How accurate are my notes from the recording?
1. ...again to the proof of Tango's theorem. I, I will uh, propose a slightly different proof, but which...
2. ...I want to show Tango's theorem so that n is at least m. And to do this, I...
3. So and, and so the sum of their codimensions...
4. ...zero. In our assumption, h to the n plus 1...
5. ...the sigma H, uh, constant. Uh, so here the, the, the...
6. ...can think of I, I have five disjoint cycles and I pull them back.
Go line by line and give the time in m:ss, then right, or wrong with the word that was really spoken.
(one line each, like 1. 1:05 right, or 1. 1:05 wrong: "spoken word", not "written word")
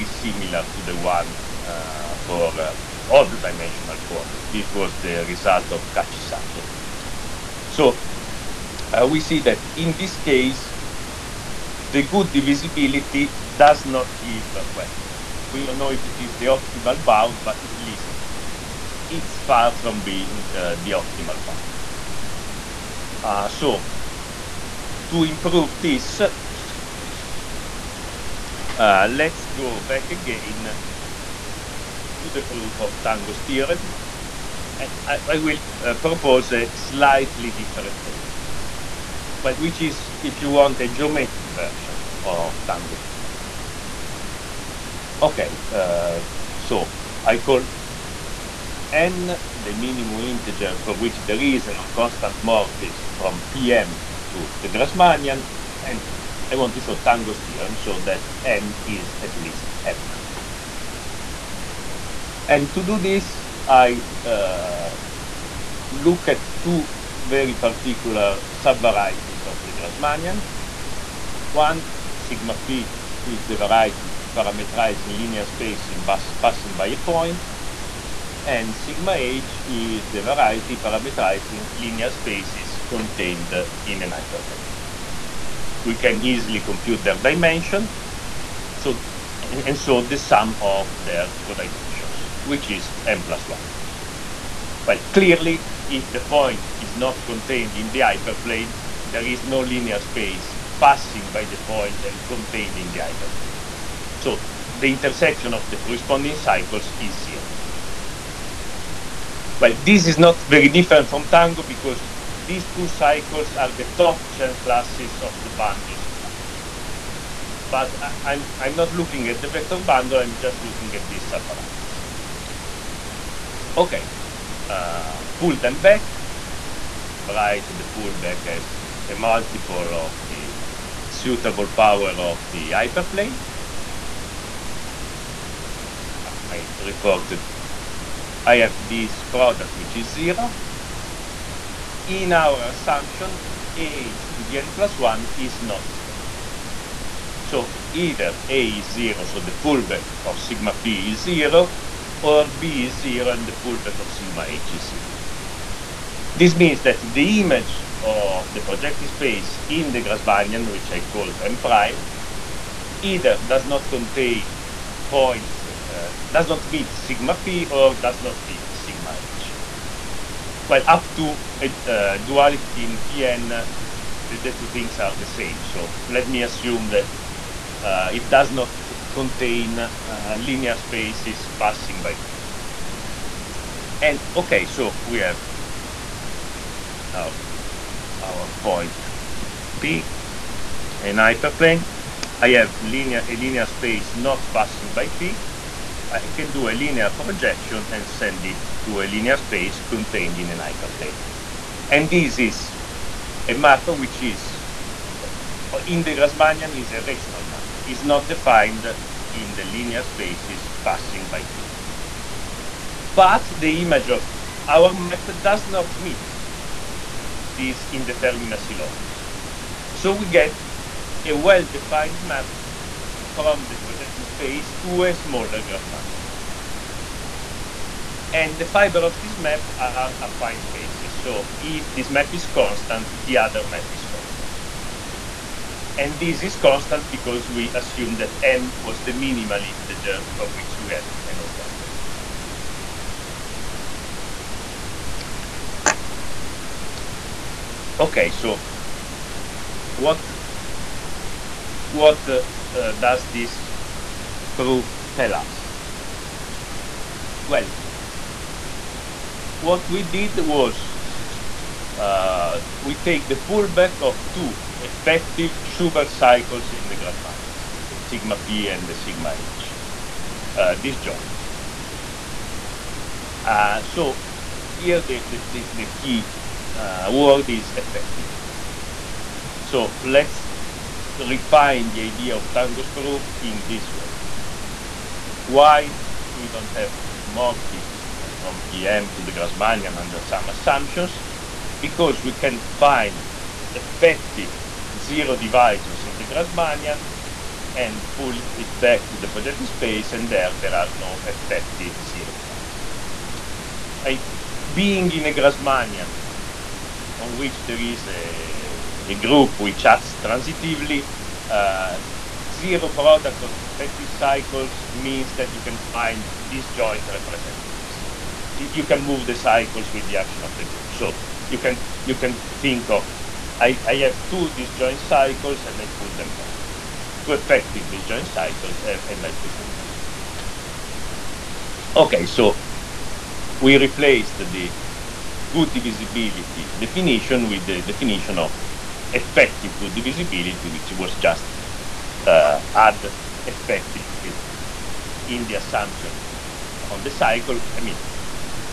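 1. 0:30 right
2. 0:56 right
3. 1:28 right
4. 2:20 right
5. 4:28 wrong: "disjoint", not "constant"
6. 5:22 wrong: "two", not "five".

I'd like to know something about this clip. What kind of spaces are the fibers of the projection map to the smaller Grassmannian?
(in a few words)
affine spaces.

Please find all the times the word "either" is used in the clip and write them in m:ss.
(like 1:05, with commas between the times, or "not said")
2:27, 2:43.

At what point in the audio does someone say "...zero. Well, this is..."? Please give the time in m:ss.
1:47.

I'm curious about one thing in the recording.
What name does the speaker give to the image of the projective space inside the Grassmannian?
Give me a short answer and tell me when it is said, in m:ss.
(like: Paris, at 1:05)
M prime, at 2:41.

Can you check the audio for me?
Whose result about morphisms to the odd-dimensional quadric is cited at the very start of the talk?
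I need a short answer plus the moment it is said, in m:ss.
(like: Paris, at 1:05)
Kachi-Sato, at 0:05.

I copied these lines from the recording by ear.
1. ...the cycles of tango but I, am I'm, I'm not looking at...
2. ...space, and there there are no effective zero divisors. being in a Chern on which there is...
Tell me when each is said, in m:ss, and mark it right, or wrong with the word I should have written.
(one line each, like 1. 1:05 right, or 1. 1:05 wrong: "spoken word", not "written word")
1. 1:55 wrong: "bundles", not "cycles"
2. 4:59 wrong: "Grassmannian", not "Chern".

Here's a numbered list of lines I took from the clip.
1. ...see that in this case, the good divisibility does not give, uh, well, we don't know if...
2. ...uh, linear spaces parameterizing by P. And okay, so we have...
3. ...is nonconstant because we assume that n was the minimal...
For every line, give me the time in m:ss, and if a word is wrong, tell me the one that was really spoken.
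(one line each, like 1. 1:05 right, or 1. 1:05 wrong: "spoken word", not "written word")
1. 0:09 right
2. 2:59 wrong: "passing", not "parameterizing"
3. 3:56 wrong: "constant", not "nonconstant".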